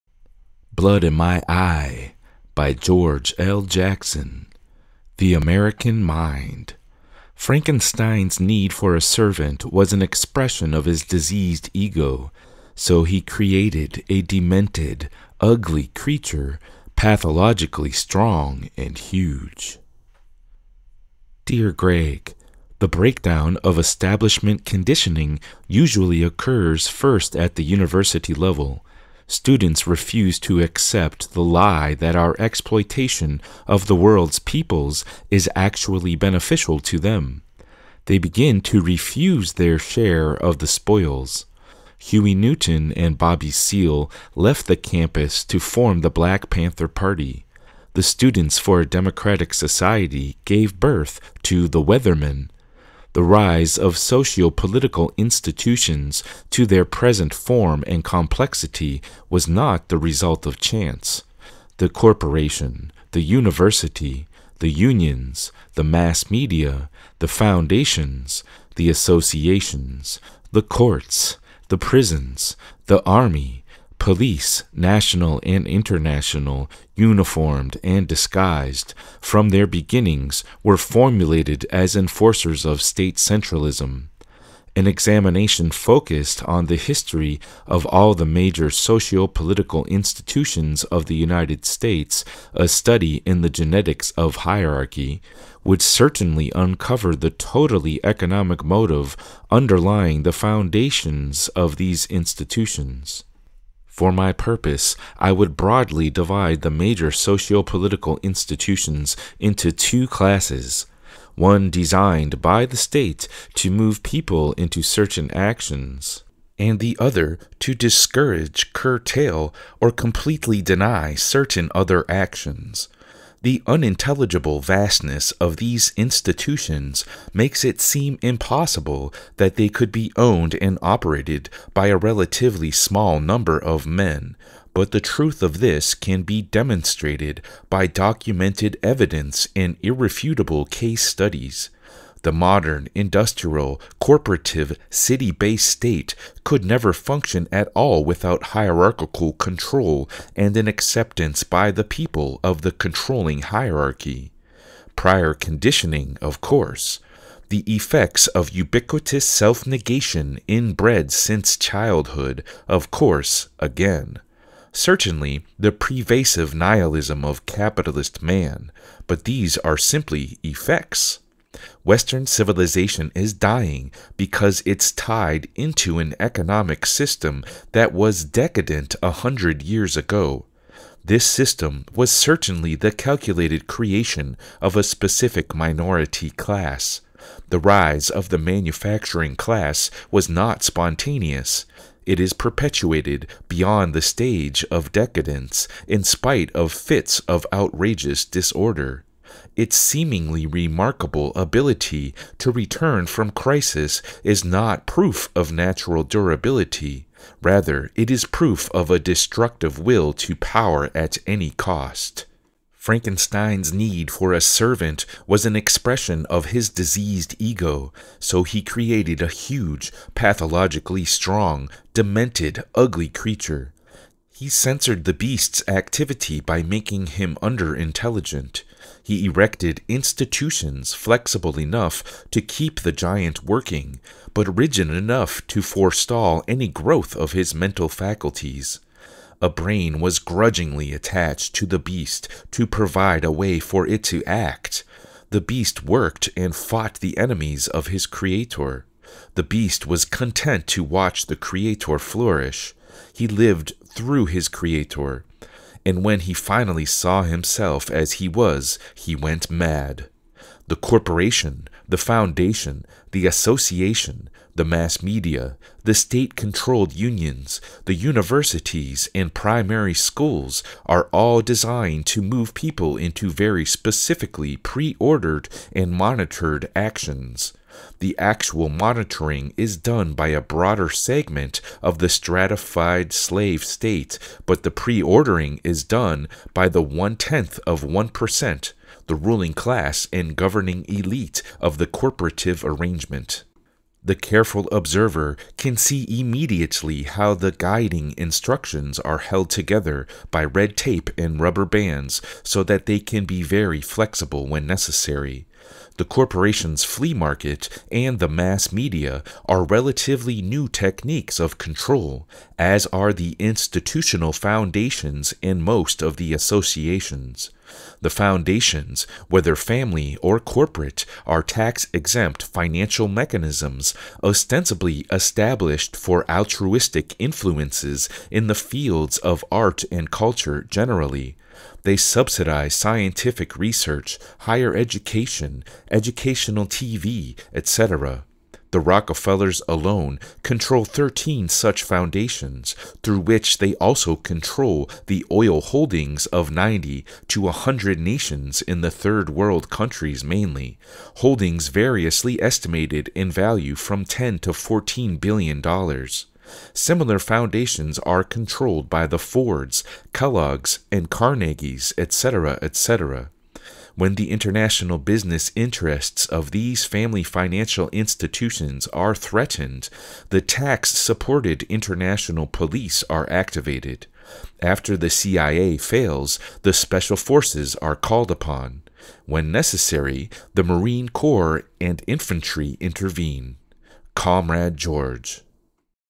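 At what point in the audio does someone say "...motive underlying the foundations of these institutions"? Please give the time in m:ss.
1:38.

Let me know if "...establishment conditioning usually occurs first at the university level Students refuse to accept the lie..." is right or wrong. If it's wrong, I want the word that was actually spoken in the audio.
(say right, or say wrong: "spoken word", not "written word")
right.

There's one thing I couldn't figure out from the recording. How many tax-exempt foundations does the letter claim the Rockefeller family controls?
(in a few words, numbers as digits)
13.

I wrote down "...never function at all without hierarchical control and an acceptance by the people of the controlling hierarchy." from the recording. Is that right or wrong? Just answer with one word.
right.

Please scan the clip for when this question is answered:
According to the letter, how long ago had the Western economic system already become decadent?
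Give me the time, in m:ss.
2:59.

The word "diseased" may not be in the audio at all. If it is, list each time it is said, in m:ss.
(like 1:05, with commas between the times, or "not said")
0:11, 3:36.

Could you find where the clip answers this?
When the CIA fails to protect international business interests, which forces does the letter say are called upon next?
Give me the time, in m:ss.
6:16.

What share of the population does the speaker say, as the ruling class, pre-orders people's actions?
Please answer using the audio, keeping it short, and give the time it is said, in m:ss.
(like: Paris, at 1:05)
One tenth of 1%, at 4:46.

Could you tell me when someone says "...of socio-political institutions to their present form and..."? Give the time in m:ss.
0:53.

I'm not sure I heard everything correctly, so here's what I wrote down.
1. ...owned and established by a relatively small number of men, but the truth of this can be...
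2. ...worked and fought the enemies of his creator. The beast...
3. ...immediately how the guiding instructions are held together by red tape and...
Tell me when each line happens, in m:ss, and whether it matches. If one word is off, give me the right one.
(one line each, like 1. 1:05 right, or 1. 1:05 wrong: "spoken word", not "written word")
1. 2:10 wrong: "operated", not "established"
2. 4:05 right
3. 4:56 right.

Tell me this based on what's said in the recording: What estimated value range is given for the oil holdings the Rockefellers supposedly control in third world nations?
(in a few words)
10 to 14 billion dollars.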